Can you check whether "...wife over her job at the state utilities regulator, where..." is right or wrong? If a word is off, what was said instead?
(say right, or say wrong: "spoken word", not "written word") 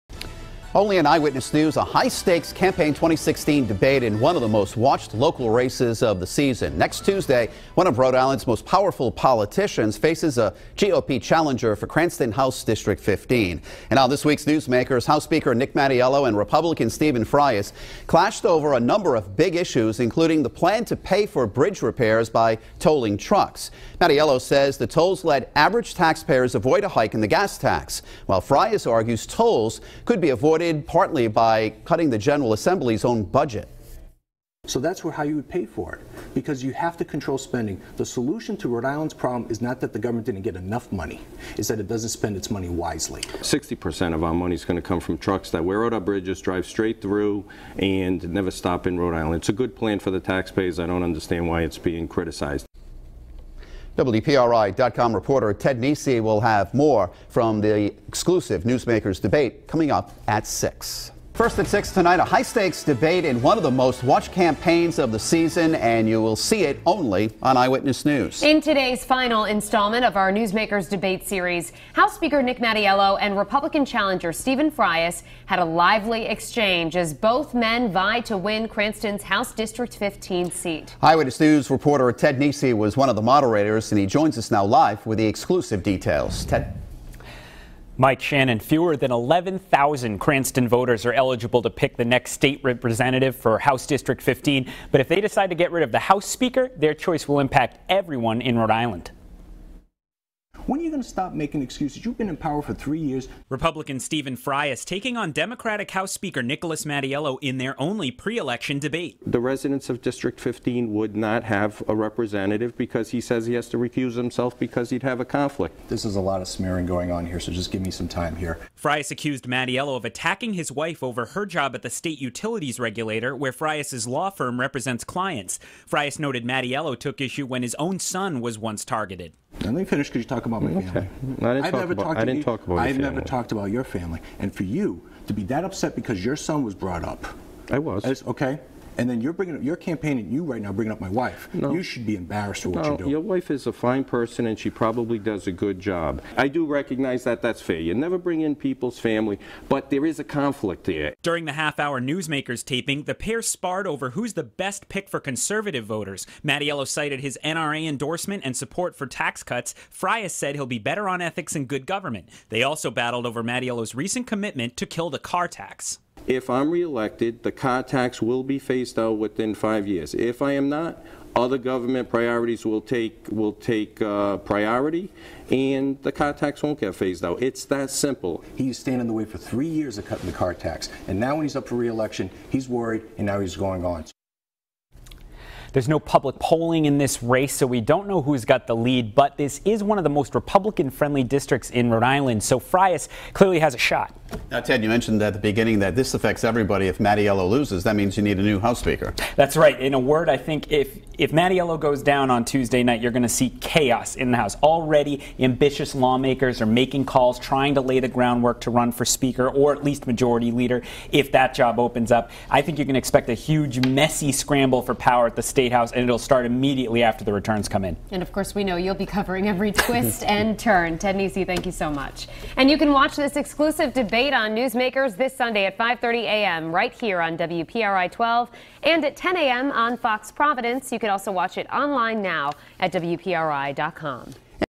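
right.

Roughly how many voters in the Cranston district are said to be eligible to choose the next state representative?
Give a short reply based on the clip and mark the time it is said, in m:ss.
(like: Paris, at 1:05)
fewer than 11,000, at 1:28.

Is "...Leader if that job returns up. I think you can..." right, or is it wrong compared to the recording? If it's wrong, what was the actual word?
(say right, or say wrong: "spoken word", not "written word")
wrong: "opens", not "returns".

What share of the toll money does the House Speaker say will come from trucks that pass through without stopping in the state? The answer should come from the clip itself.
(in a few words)
60%.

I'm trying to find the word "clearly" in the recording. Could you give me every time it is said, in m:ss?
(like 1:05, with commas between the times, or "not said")
3:13.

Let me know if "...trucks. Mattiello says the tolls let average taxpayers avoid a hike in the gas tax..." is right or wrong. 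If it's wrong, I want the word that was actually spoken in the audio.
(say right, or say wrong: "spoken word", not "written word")
right.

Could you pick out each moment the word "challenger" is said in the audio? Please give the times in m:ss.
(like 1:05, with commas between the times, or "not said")
0:11, 1:13.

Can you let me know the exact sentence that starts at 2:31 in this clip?
During the half hour Newsmakers taping, the pair sparred over who's the best pick for conservative voters.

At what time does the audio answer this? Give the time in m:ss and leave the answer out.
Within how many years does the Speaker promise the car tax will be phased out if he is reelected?
2:49.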